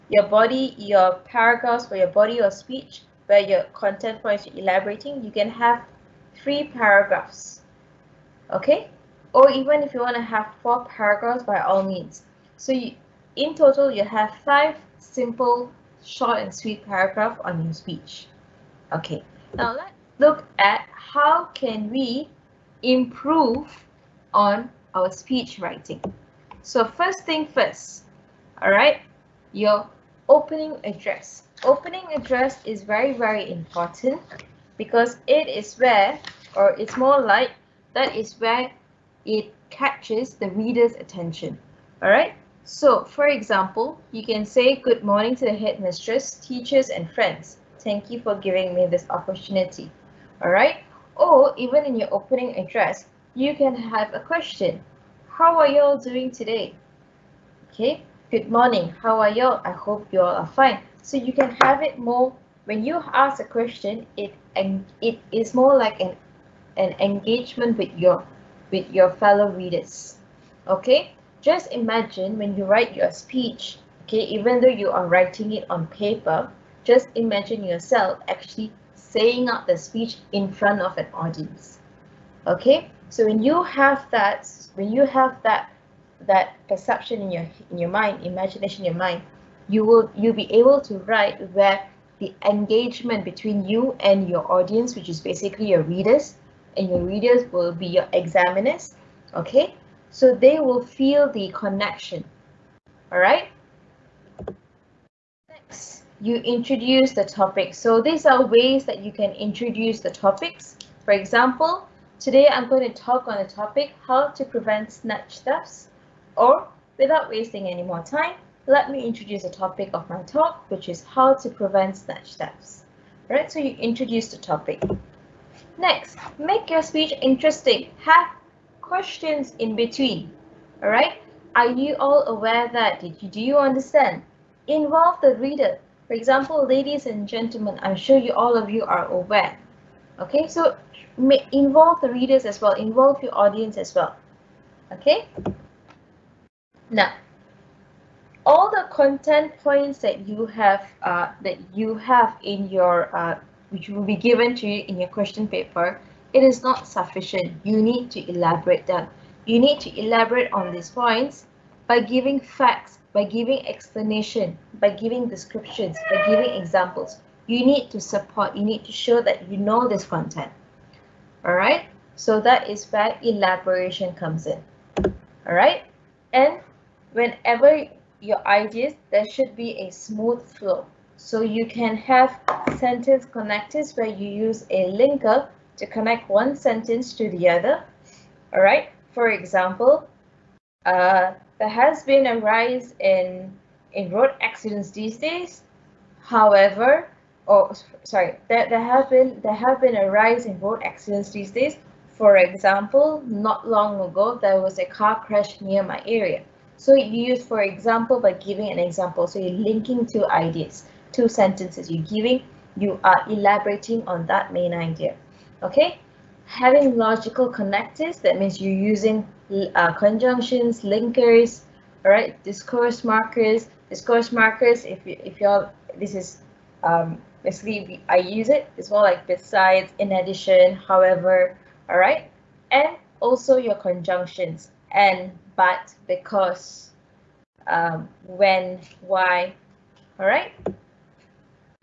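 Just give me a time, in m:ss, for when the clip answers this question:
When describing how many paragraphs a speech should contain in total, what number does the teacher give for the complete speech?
0:14.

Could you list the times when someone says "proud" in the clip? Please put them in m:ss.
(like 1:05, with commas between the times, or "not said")
not said.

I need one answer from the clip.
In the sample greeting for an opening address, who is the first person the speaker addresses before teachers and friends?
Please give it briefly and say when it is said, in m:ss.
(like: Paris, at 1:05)
the headmistress, at 0:45.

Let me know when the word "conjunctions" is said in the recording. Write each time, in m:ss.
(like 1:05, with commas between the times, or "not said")
3:39, 3:53.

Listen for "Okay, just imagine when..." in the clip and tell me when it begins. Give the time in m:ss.
1:10.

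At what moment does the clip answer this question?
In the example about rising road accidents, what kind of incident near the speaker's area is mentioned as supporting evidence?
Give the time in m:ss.
3:24.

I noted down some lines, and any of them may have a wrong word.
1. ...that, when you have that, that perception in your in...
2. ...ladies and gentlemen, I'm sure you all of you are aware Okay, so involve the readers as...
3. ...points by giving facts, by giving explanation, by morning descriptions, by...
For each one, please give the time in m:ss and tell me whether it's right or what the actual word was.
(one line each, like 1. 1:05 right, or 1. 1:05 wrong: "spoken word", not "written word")
1. 1:24 right
2. 2:16 right
3. 2:40 wrong: "giving", not "morning".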